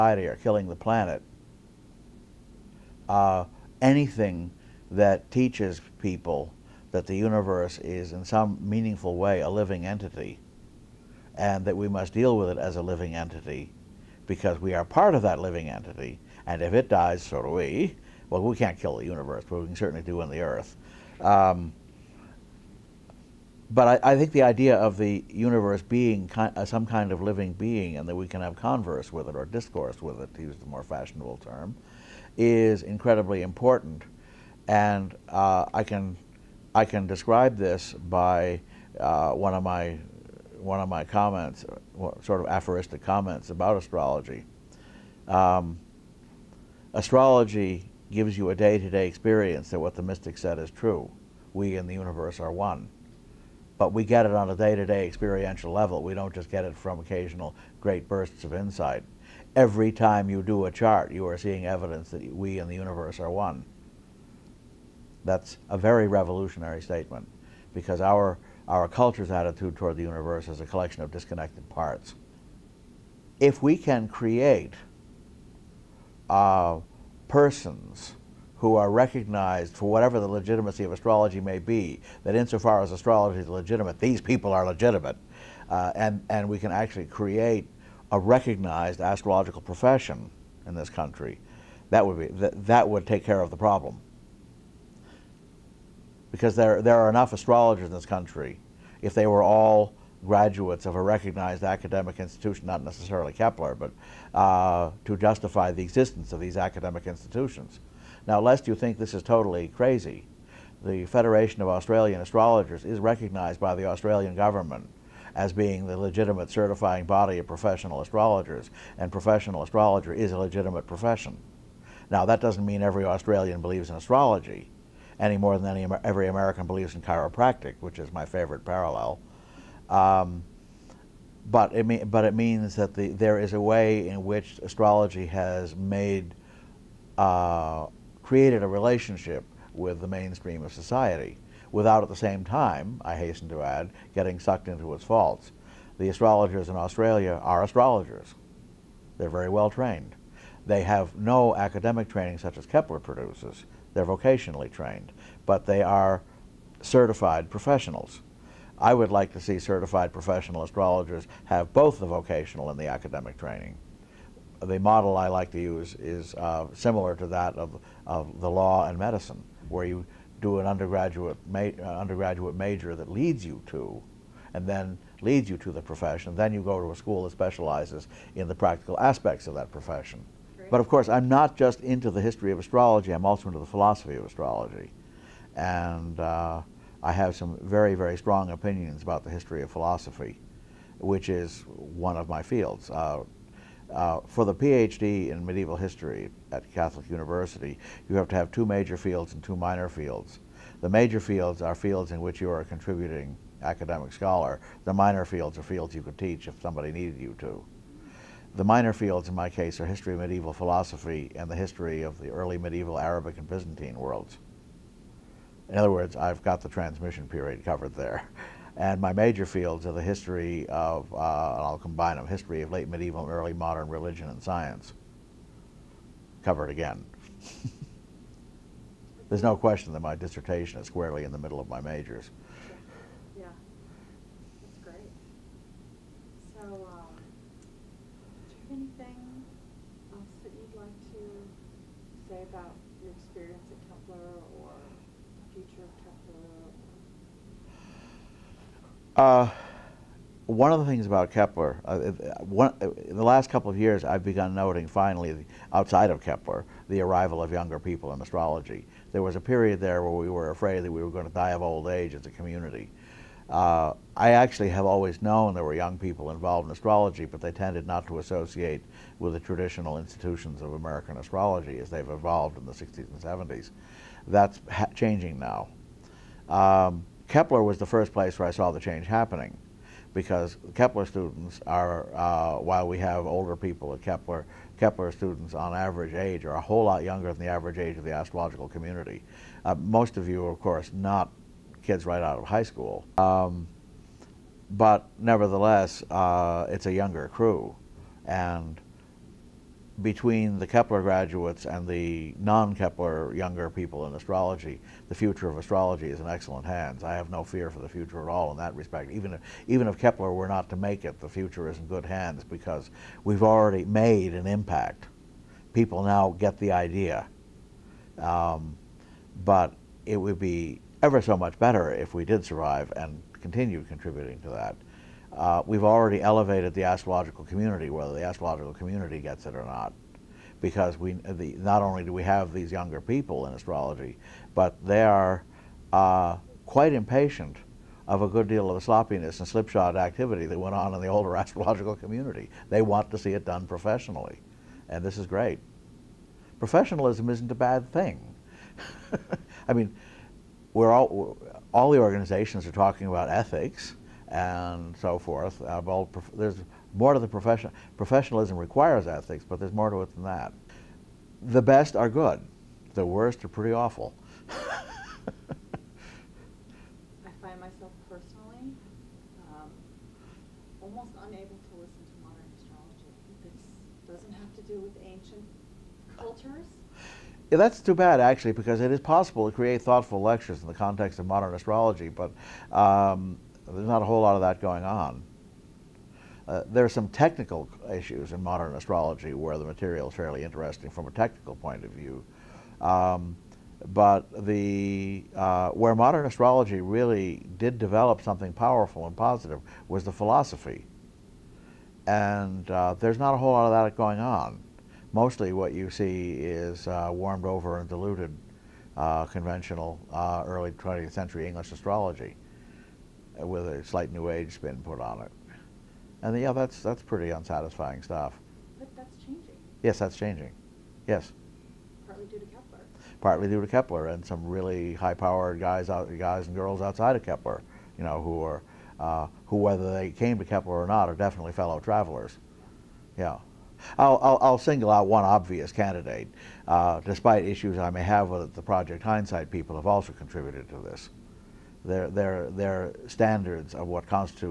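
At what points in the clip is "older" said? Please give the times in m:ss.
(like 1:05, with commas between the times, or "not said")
4:43, 5:41.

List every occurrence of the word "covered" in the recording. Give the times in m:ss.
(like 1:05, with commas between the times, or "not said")
3:37, 3:46.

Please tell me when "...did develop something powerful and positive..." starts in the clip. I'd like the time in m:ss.
6:37.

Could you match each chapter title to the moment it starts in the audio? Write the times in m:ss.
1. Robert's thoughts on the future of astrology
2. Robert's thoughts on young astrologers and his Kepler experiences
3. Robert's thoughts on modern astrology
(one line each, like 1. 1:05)
1. 1:11
2. 4:08
3. 6:17.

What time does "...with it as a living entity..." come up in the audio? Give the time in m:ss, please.
0:12.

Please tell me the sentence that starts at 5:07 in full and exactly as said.
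I have no fear for the future at all in that respect.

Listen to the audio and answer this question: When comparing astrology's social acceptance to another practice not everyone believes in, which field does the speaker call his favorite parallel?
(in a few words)
chiropractic.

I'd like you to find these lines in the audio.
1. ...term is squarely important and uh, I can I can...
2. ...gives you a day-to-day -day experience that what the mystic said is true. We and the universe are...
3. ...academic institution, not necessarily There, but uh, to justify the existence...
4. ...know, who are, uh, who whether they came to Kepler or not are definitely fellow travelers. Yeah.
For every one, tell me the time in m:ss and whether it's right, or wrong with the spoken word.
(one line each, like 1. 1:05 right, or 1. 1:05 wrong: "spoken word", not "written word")
1. 0:31 wrong: "incredibly", not "squarely"
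2. 0:48 right
3. 1:41 wrong: "Kepler", not "There"
4. 7:08 right.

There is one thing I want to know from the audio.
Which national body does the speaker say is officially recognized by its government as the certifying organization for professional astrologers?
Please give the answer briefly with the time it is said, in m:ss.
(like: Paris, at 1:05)
Federation of Australian Astrologers, at 1:51.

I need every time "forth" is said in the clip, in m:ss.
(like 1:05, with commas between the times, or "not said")
5:55.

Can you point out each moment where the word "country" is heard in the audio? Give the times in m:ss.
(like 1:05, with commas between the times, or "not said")
1:30, 1:38.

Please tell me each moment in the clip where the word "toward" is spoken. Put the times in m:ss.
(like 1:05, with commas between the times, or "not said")
1:09.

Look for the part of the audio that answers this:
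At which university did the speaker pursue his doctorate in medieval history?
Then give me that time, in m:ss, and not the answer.
3:16.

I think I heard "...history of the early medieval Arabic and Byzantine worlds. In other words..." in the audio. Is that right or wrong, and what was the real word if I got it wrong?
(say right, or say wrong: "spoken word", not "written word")
right.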